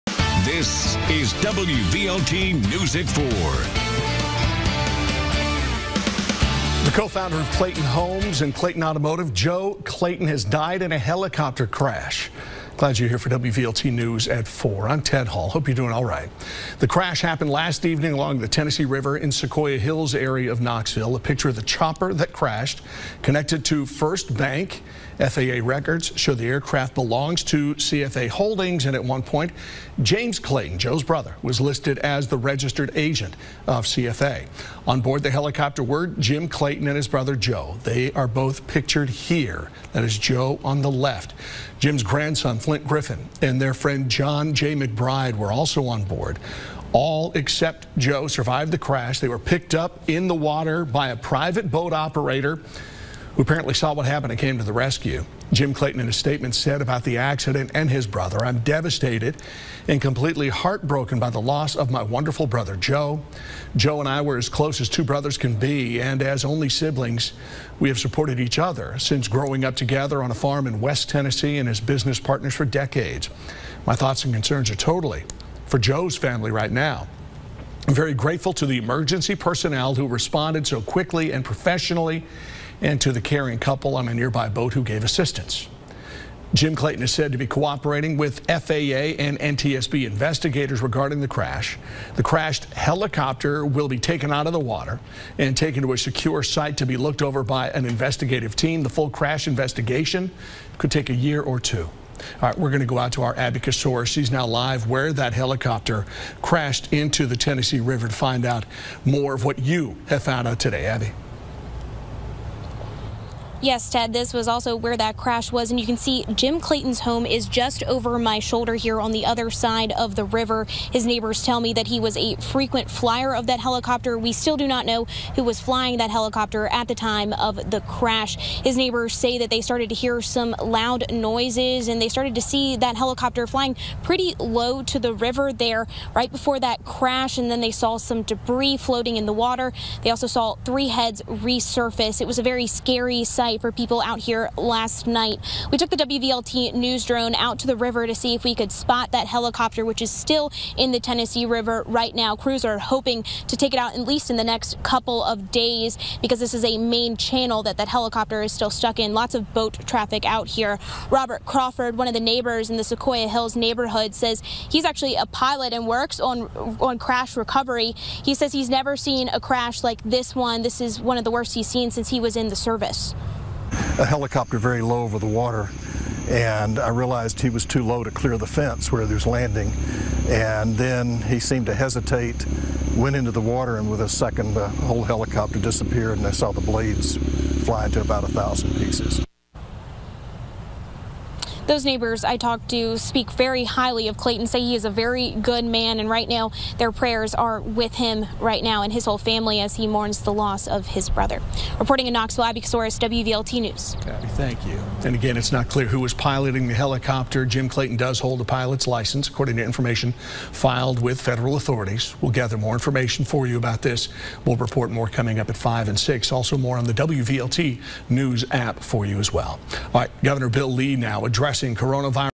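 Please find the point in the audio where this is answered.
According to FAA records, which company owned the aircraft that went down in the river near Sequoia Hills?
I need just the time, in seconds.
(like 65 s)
27 s.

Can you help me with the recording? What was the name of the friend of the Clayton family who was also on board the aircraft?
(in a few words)
John J. McBride.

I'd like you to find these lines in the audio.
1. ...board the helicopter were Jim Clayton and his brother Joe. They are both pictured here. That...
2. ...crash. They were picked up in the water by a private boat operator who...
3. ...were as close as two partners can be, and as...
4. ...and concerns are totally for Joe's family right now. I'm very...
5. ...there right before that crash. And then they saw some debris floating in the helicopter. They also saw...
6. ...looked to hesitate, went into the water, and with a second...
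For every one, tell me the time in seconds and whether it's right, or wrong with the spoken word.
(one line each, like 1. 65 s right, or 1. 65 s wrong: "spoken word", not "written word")
1. 34 s right
2. 48 s right
3. 64 s wrong: "brothers", not "partners"
4. 74 s right
5. 135 s wrong: "water", not "helicopter"
6. 181 s wrong: "seemed", not "looked".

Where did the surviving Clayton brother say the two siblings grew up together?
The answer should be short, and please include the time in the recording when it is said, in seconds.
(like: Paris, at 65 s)
West Tennessee, at 70 s.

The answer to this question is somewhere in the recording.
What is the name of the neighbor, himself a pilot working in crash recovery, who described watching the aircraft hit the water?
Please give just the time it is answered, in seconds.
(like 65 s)
161 s.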